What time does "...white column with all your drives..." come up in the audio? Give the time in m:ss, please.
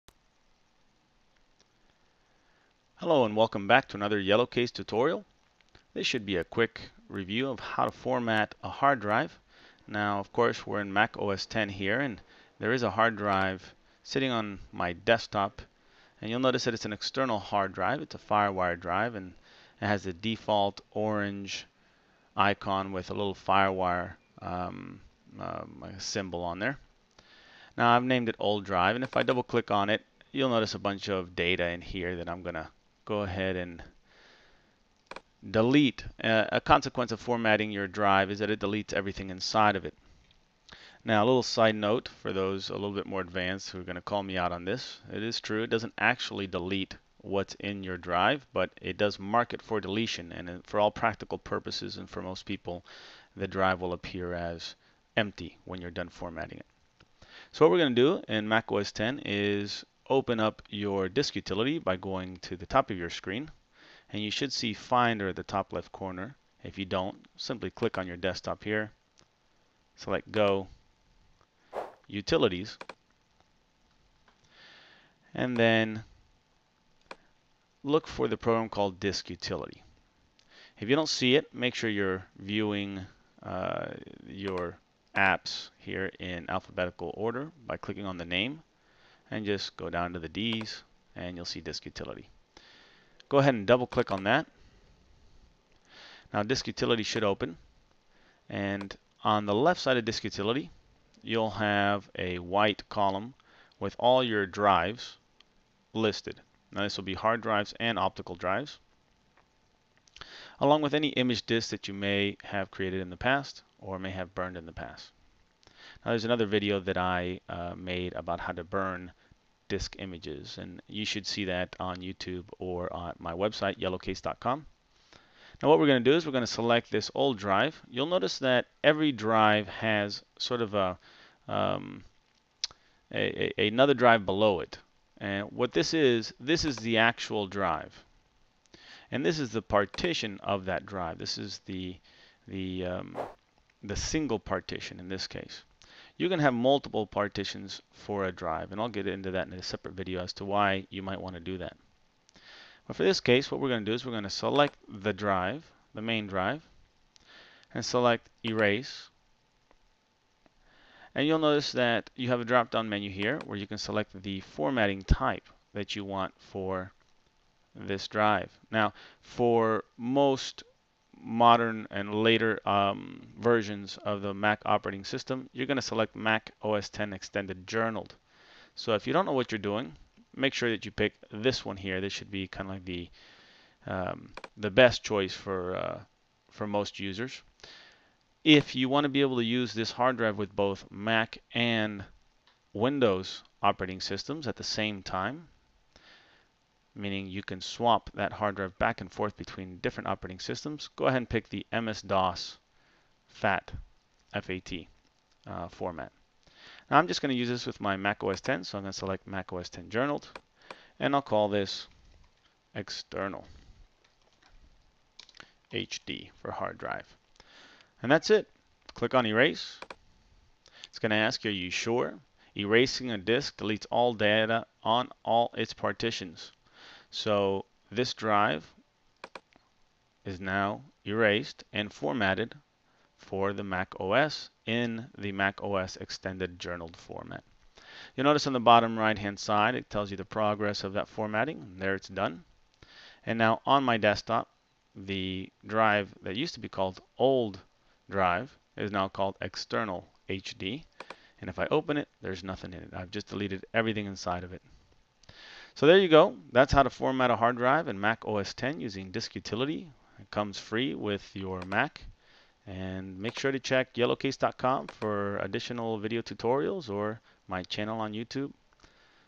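1:42.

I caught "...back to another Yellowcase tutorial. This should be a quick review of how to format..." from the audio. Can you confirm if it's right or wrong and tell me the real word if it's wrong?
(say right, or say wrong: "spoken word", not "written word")
right.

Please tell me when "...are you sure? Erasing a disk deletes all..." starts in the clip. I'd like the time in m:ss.
3:41.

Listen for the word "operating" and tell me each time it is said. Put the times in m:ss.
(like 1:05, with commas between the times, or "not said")
2:54, 3:13, 3:20.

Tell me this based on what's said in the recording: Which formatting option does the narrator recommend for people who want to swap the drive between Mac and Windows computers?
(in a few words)
MS-DOS FAT.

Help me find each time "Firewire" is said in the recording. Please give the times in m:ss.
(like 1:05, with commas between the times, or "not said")
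0:18, 0:23.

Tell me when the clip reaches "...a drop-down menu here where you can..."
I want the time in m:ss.
2:42.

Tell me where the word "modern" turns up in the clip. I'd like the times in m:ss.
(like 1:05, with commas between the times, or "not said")
2:51.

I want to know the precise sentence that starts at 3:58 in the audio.
You'll notice on the bottom right hand side it tells you the progress of that formatting.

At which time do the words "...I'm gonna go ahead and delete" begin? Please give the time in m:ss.
0:32.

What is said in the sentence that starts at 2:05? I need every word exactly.
Now what we're going to do is we're going to select this old drive.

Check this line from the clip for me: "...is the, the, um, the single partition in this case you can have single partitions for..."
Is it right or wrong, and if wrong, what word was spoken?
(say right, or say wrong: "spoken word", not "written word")
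wrong: "multiple", not "single".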